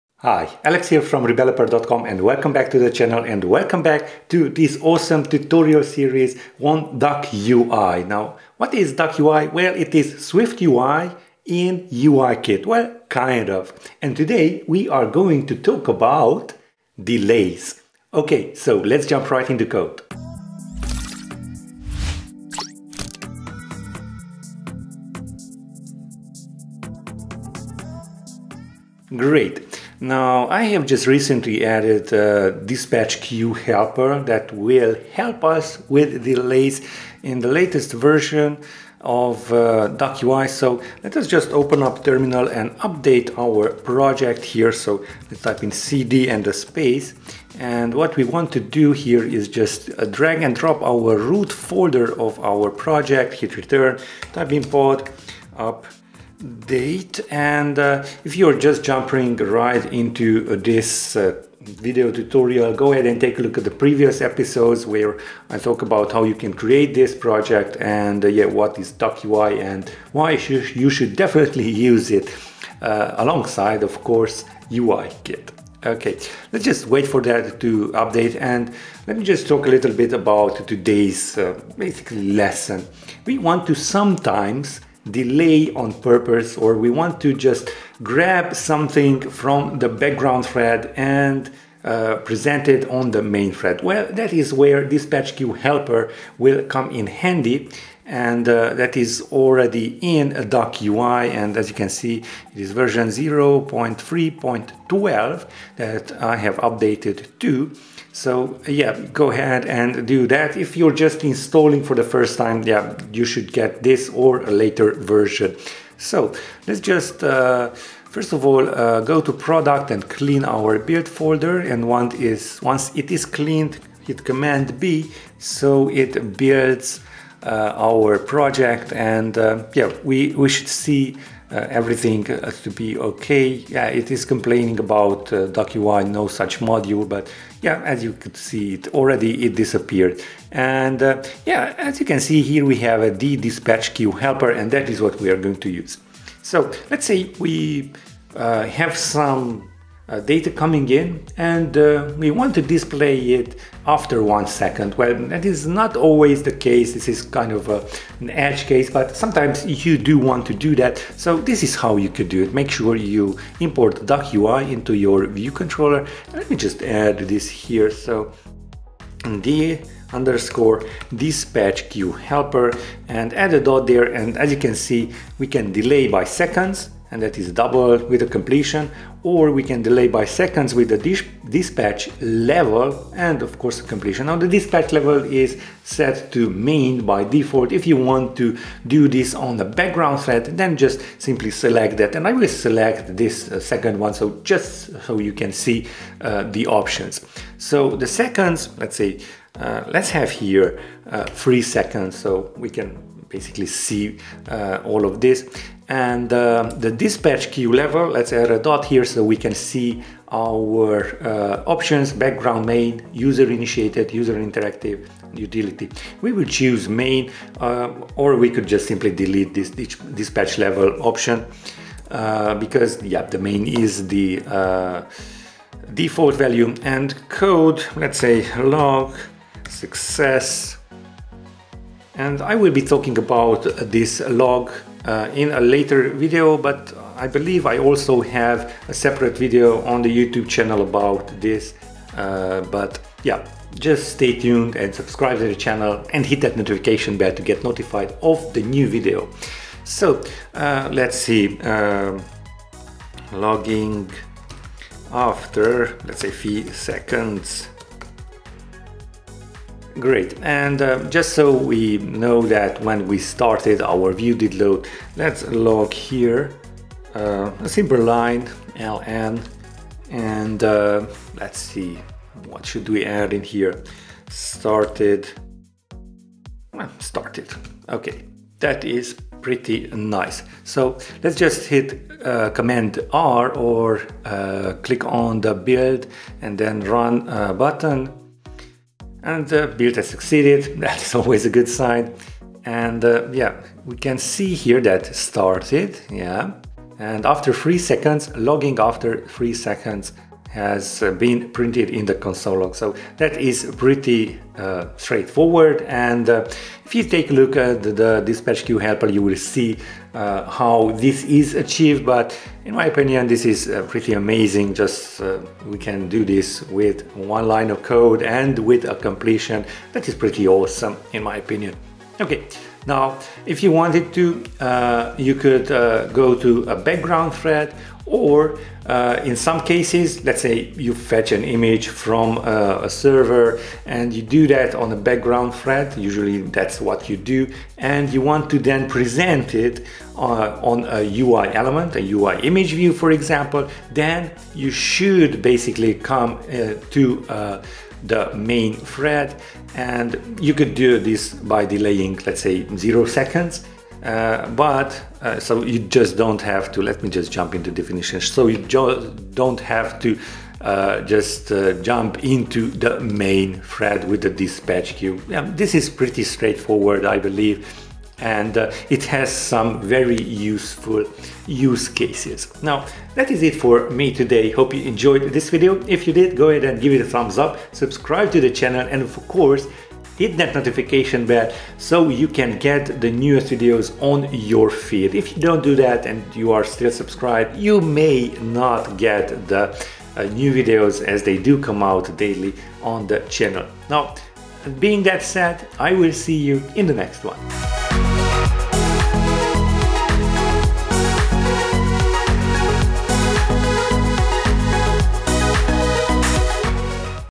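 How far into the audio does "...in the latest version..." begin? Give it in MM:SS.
00:37.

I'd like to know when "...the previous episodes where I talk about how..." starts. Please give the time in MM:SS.
01:03.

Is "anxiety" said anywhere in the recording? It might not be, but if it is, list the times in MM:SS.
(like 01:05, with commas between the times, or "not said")
not said.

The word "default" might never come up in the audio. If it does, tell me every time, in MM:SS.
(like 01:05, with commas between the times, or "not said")
03:07, 03:45.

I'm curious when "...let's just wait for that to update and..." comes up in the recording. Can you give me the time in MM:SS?
01:16.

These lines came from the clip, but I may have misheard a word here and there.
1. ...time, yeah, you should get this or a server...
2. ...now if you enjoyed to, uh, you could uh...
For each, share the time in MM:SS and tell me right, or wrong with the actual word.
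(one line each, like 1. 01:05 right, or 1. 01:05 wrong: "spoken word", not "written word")
1. 01:52 wrong: "later", not "server"
2. 05:22 wrong: "wanted", not "enjoyed".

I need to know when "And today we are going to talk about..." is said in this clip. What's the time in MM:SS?
00:13.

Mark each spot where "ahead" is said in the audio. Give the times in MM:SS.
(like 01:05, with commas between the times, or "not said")
01:02, 01:49, 06:16.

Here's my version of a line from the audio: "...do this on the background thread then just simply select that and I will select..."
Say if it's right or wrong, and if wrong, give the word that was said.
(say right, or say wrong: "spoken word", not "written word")
right.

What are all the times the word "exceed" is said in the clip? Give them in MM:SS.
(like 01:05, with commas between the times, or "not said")
not said.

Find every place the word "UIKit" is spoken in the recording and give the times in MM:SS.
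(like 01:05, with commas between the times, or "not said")
00:11.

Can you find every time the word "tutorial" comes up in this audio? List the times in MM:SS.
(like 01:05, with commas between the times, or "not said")
00:05, 01:02.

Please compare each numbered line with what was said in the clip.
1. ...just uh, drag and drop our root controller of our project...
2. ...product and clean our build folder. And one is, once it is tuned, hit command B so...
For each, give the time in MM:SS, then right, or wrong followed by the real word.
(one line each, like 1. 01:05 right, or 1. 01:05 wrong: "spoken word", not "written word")
1. 00:49 wrong: "folder", not "controller"
2. 01:59 wrong: "cleaned", not "tuned".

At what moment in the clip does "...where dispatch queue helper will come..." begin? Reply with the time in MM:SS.
01:34.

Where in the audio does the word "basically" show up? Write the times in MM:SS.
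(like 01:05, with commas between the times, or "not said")
01:21, 03:23, 05:45.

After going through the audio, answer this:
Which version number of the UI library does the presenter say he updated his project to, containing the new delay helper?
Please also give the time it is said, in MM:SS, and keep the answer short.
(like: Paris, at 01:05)
0.3.12, at 01:43.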